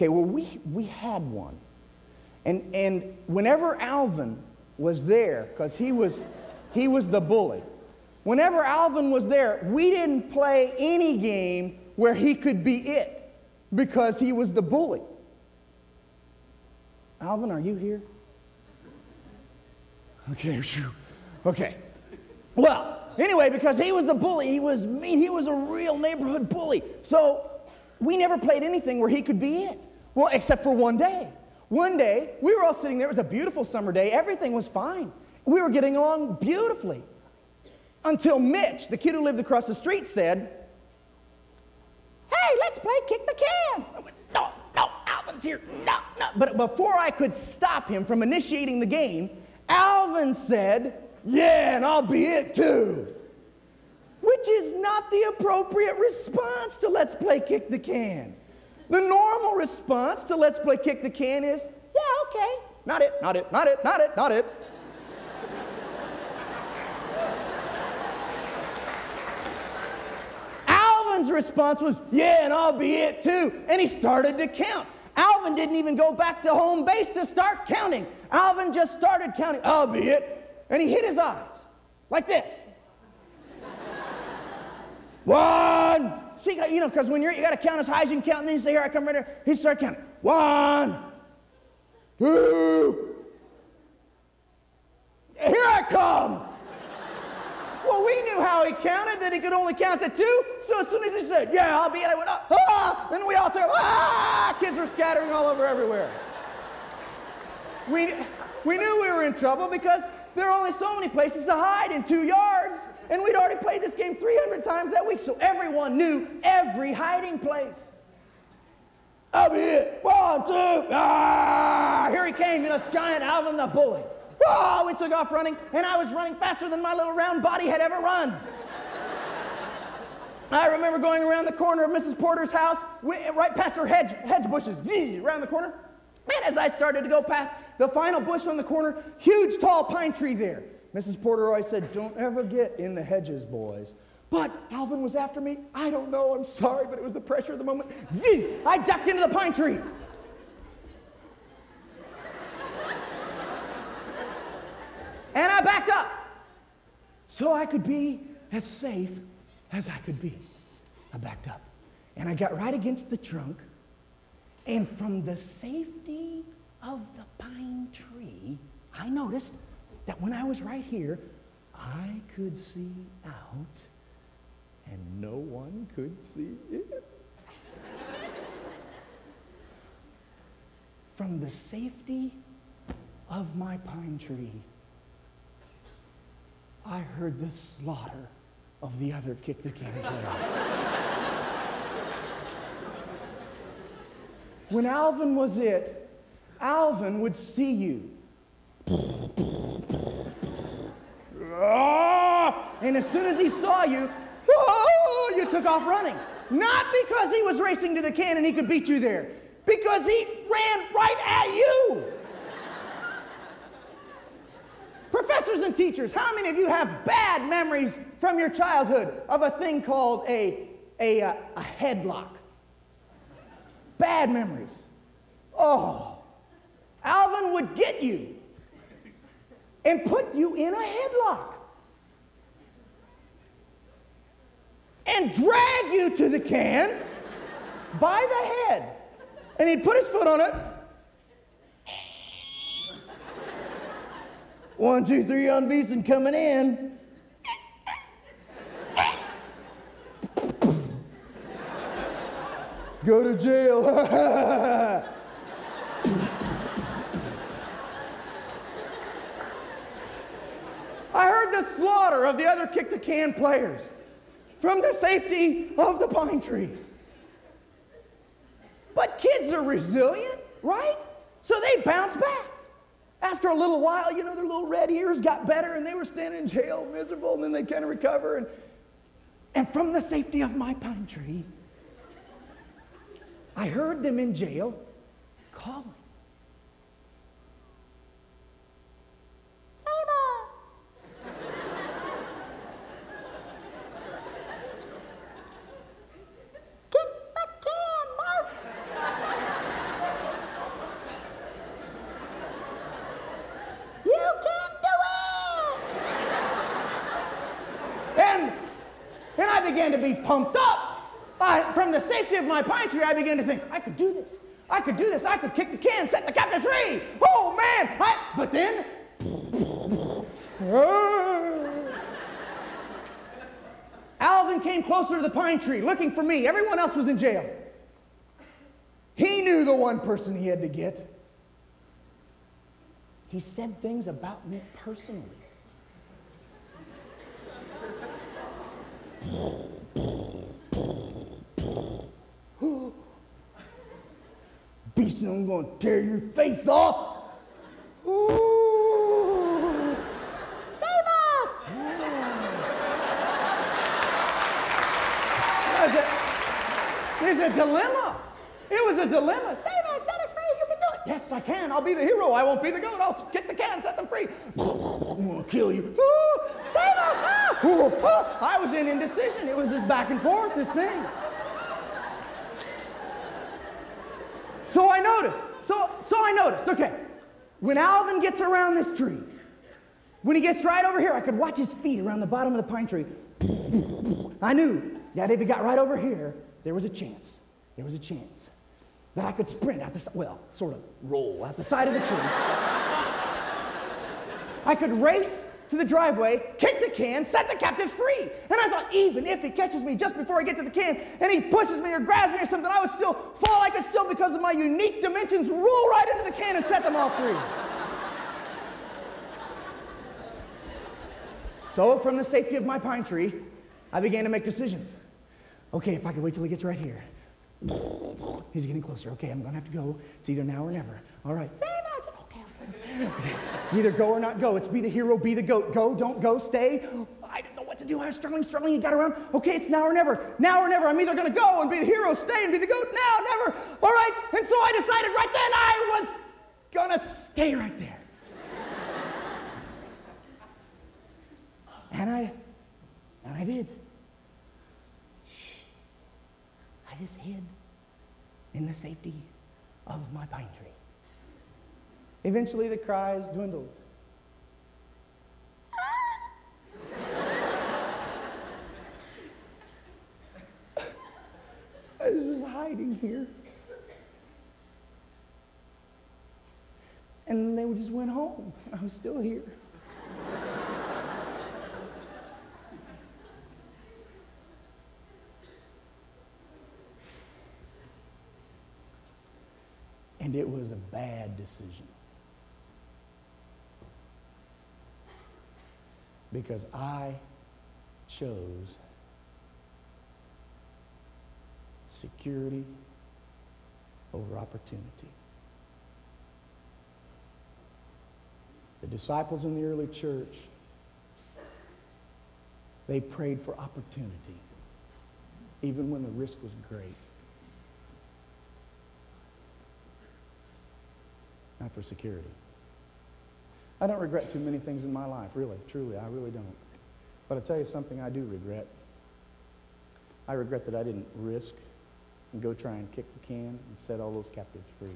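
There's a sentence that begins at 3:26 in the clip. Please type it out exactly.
Not because he was racing to the can and he could beat you there, because he ran right at you.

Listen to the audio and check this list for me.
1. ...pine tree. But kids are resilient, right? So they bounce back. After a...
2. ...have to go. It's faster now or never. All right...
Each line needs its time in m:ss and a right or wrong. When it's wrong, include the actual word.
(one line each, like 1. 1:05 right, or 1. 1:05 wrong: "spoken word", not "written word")
1. 4:26 right
2. 6:59 wrong: "either", not "faster".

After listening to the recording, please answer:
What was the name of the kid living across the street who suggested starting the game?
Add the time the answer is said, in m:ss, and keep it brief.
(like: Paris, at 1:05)
Mitch, at 0:38.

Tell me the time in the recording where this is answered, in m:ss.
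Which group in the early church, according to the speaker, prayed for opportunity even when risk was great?
8:18.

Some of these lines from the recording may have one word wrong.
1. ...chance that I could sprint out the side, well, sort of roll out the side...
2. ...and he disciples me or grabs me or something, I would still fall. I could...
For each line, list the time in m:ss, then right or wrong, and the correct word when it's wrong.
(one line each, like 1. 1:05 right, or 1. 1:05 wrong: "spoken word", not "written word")
1. 6:27 right
2. 6:41 wrong: "pushes", not "disciples".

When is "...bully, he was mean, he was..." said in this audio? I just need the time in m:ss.
0:24.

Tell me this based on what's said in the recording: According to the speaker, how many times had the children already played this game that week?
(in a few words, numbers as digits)
300.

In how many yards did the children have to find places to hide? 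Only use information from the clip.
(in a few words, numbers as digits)
2.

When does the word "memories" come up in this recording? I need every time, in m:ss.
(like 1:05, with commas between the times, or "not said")
3:37, 3:44.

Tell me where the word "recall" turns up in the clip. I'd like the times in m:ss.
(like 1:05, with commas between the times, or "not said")
not said.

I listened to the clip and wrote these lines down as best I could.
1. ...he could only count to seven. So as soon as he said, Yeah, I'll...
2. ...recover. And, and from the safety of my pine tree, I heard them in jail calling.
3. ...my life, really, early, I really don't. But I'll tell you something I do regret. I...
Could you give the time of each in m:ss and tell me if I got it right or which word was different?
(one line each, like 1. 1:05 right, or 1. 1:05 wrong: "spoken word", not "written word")
1. 1:39 wrong: "two", not "seven"
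2. 4:37 right
3. 8:34 wrong: "truly", not "early".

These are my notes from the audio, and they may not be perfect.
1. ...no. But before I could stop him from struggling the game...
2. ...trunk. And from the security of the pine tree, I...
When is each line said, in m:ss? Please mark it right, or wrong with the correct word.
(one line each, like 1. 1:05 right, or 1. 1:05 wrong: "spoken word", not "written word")
1. 0:46 wrong: "initiating", not "struggling"
2. 2:43 wrong: "safety", not "security".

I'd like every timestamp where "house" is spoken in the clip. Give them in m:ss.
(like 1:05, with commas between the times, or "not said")
2:12.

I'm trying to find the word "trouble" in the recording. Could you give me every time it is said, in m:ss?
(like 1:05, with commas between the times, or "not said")
1:49.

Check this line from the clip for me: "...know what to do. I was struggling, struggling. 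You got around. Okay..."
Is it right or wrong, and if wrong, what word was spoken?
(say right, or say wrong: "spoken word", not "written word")
right.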